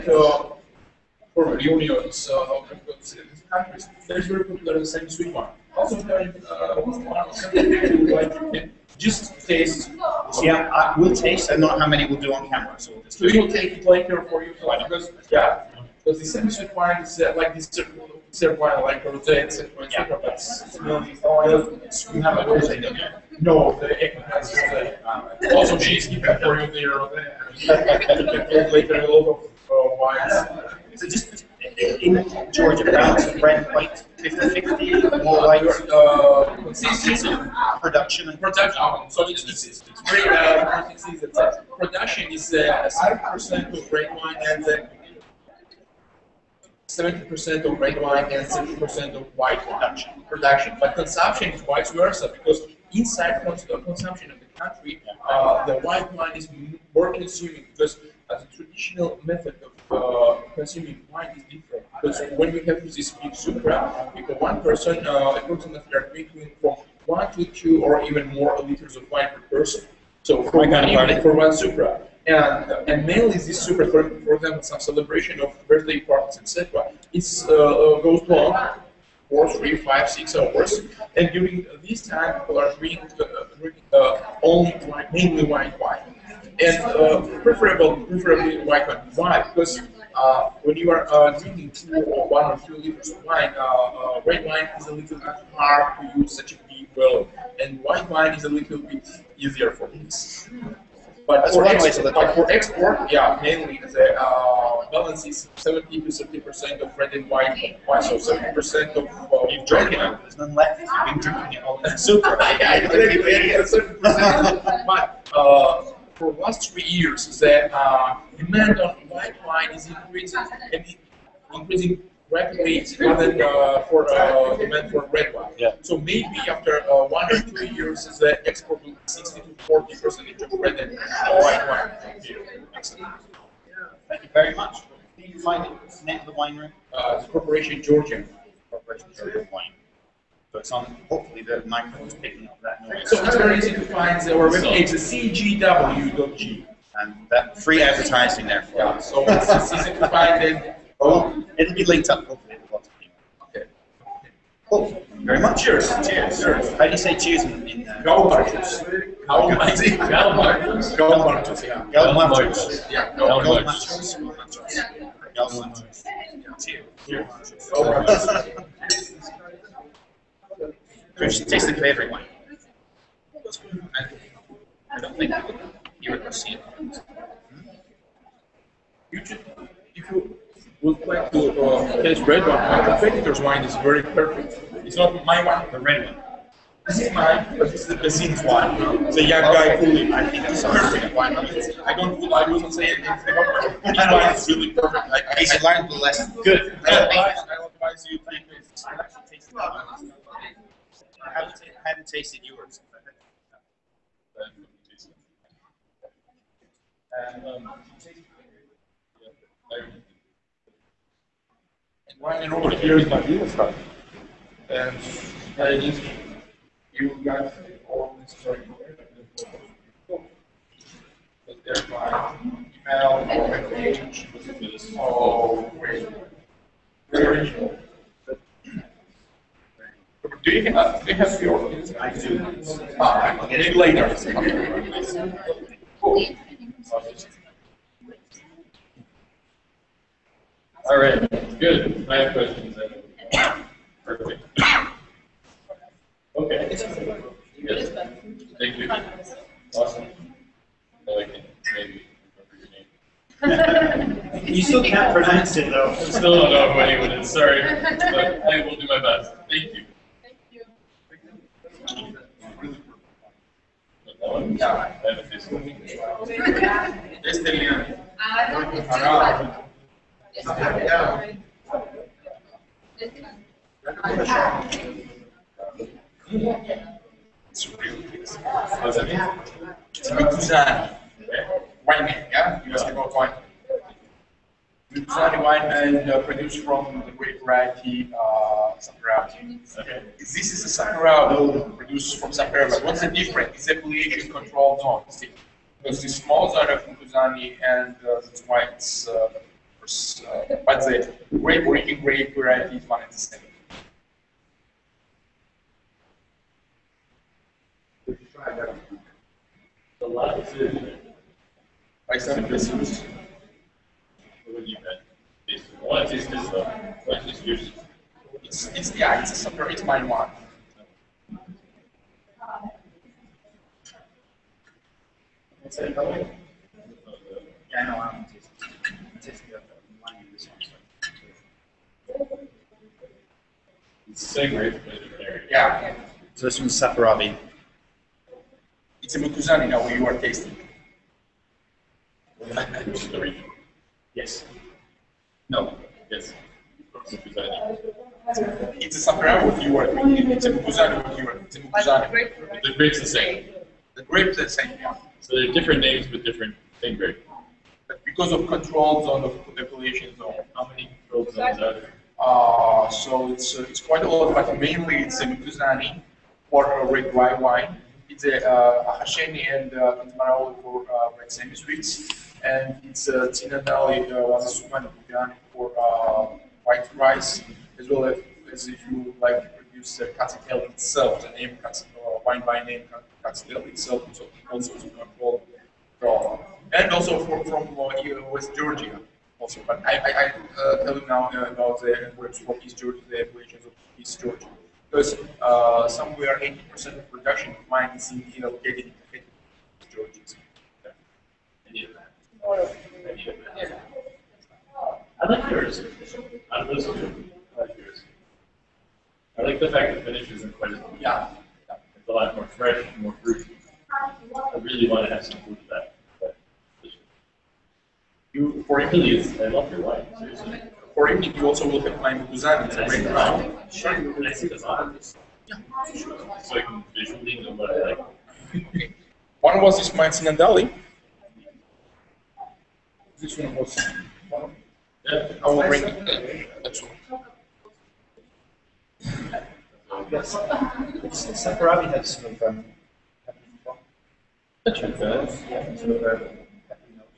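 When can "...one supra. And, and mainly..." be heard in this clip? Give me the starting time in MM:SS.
01:11.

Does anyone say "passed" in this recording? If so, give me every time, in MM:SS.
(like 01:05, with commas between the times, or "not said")
not said.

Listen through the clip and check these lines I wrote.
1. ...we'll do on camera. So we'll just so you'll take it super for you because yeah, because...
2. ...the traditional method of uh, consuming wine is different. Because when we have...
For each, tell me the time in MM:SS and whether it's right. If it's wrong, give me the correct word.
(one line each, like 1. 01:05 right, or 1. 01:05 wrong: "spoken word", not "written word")
1. 00:12 wrong: "later", not "super"
2. 00:58 right.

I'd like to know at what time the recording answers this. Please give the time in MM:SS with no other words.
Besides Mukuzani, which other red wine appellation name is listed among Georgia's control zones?
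06:09.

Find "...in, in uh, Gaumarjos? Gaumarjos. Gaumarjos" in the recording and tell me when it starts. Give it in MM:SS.
02:37.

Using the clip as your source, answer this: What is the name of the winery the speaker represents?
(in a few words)
Corporation Georgian Wine.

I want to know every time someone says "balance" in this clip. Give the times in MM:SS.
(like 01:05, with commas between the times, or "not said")
01:44.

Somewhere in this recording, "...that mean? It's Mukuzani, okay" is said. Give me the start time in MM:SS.
04:38.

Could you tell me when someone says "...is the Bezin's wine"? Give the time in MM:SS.
03:07.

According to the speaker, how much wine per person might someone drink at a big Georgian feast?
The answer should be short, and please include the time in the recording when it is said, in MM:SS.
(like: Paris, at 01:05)
1 to 2 liters, at 01:07.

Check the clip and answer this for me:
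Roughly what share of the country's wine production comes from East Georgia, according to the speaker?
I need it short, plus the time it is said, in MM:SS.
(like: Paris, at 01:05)
80%, at 06:36.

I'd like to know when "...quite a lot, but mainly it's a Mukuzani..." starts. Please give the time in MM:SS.
06:03.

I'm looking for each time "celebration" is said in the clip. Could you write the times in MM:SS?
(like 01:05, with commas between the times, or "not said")
01:14.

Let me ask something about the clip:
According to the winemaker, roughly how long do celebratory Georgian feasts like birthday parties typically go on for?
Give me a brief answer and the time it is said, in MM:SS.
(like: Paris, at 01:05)
3 to 6 hours, at 01:19.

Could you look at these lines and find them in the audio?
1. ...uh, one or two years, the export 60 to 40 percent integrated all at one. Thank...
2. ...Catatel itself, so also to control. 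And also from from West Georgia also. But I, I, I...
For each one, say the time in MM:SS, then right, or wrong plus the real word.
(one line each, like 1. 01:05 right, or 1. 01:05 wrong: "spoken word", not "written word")
1. 02:06 right
2. 06:23 right.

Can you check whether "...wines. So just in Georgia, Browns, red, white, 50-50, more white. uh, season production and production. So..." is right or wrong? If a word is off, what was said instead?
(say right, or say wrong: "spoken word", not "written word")
right.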